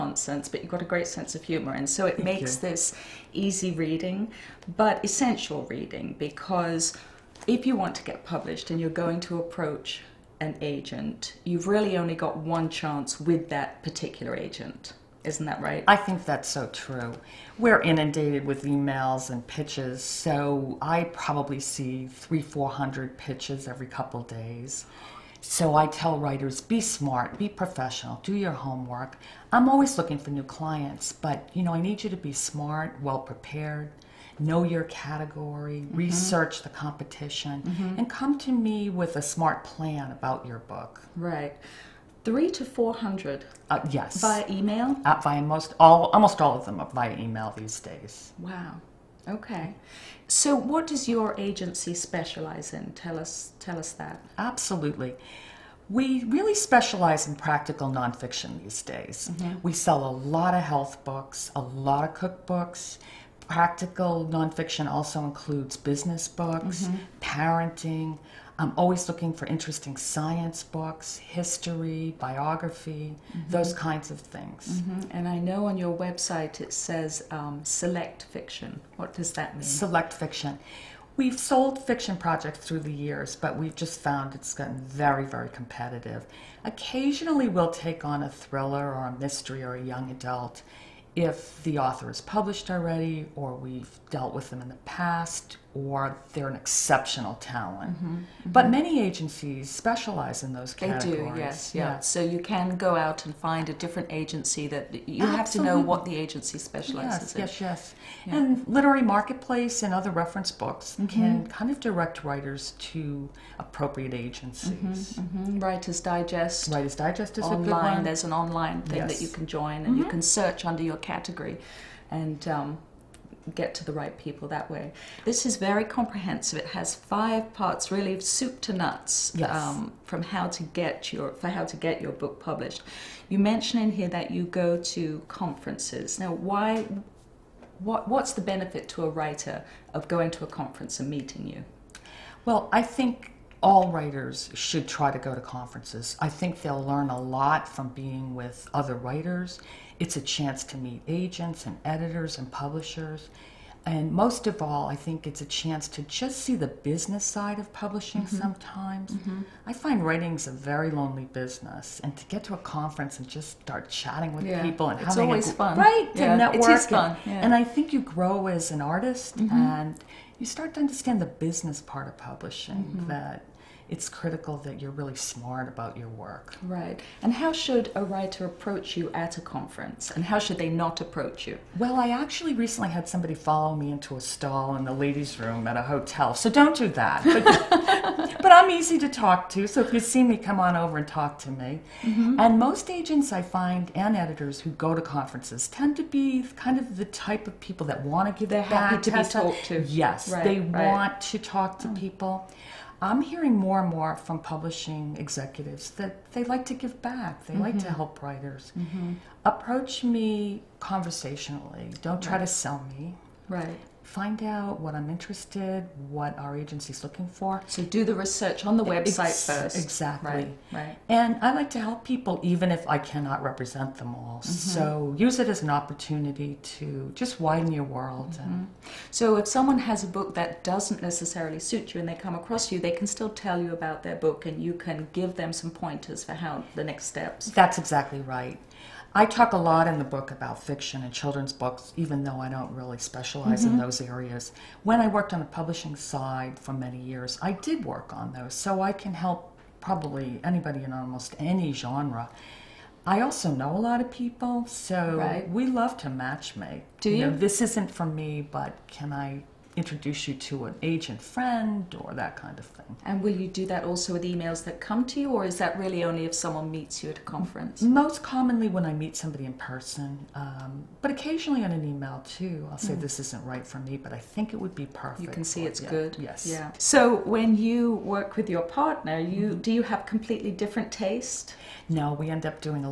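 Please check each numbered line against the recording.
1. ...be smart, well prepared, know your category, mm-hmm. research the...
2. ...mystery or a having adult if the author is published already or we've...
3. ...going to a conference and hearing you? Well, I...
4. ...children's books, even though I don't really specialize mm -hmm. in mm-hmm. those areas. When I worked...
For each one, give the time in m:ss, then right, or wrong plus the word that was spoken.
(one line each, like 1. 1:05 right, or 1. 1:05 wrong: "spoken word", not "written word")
1. 0:32 right
2. 1:29 wrong: "young", not "having"
3. 2:20 wrong: "meeting", not "hearing"
4. 4:01 right.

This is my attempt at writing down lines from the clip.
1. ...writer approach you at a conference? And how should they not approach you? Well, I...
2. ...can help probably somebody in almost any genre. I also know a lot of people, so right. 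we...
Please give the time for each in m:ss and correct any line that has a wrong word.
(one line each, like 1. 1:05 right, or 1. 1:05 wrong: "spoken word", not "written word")
1. 2:58 right
2. 4:08 wrong: "anybody", not "somebody".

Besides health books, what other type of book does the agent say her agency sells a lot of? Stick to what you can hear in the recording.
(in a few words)
Cookbooks.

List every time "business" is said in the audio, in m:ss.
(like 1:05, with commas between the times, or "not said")
1:05, 2:36, 2:41, 2:51.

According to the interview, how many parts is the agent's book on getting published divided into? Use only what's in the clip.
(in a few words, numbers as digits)
5.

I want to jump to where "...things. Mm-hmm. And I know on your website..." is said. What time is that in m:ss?
1:14.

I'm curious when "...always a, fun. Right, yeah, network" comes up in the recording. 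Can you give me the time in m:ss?
2:45.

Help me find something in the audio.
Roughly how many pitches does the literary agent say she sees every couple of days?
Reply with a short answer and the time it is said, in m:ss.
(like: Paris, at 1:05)
300 to 400, at 0:22.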